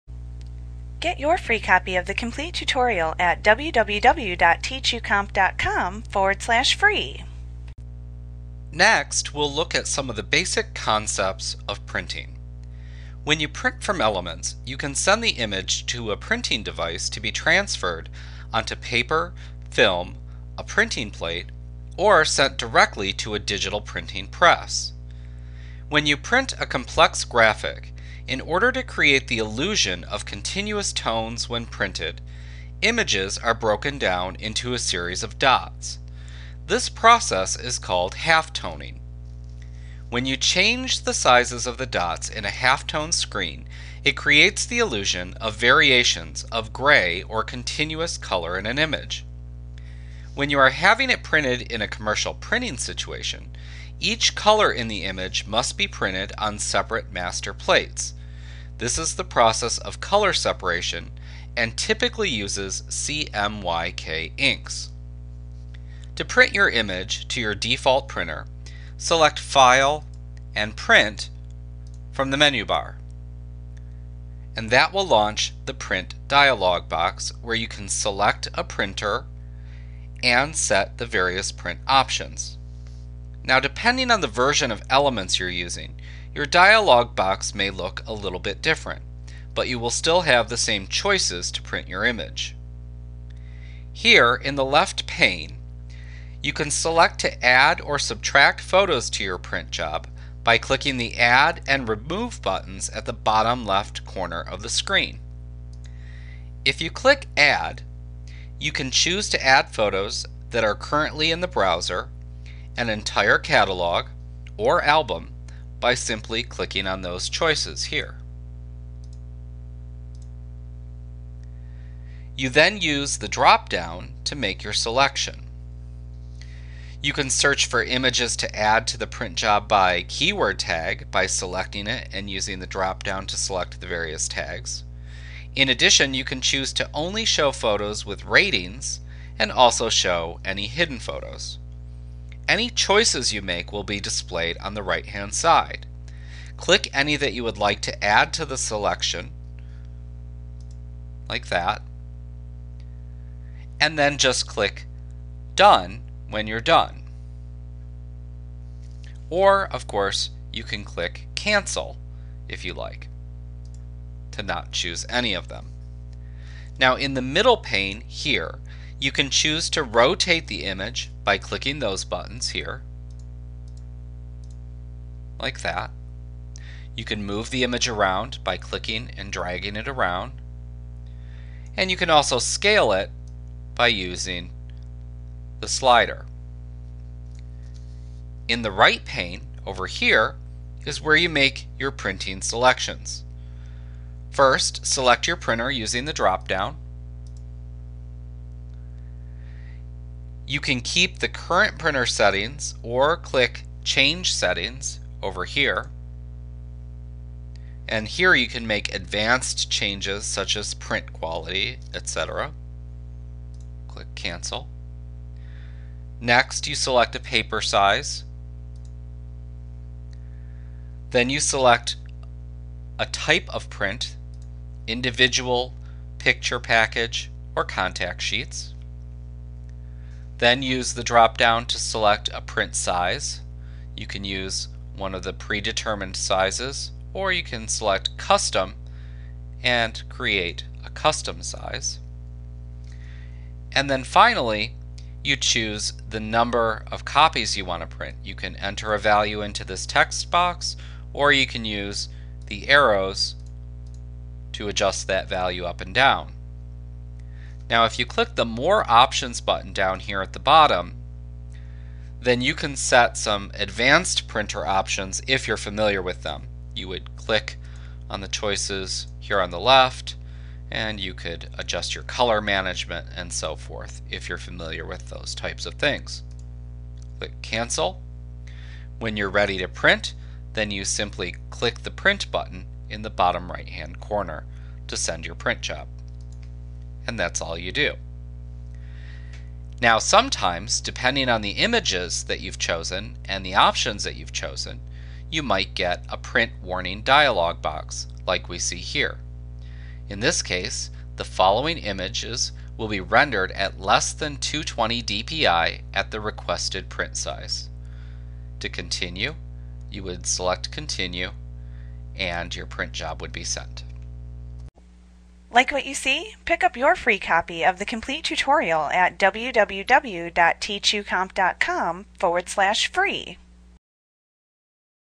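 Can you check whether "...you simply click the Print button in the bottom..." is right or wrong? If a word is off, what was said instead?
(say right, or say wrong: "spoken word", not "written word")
right.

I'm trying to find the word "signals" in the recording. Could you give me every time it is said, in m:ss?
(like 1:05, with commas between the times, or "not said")
not said.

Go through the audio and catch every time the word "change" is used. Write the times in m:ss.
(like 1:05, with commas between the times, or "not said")
0:40, 3:23, 3:29.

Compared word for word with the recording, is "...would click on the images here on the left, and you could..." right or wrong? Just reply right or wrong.
wrong.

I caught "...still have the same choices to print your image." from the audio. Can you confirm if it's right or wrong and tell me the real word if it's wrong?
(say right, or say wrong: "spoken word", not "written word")
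right.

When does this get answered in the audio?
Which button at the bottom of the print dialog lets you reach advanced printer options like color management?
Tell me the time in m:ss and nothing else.
4:18.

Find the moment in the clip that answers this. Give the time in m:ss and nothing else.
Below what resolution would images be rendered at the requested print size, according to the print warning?
5:04.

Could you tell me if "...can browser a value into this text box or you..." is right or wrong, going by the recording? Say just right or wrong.
wrong.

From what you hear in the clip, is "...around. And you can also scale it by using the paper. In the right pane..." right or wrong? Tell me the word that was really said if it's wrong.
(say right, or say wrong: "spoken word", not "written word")
wrong: "slider", not "paper".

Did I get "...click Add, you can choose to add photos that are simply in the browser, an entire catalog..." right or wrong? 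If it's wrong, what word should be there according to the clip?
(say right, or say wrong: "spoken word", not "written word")
wrong: "currently", not "simply".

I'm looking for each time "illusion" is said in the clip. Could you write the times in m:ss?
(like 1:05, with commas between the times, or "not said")
0:29, 0:44.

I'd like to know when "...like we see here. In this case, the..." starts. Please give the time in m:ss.
4:58.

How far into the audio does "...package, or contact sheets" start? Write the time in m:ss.
3:46.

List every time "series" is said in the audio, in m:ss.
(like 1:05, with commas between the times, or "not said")
0:34.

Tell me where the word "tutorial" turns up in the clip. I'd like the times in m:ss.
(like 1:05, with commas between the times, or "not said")
0:02, 5:18.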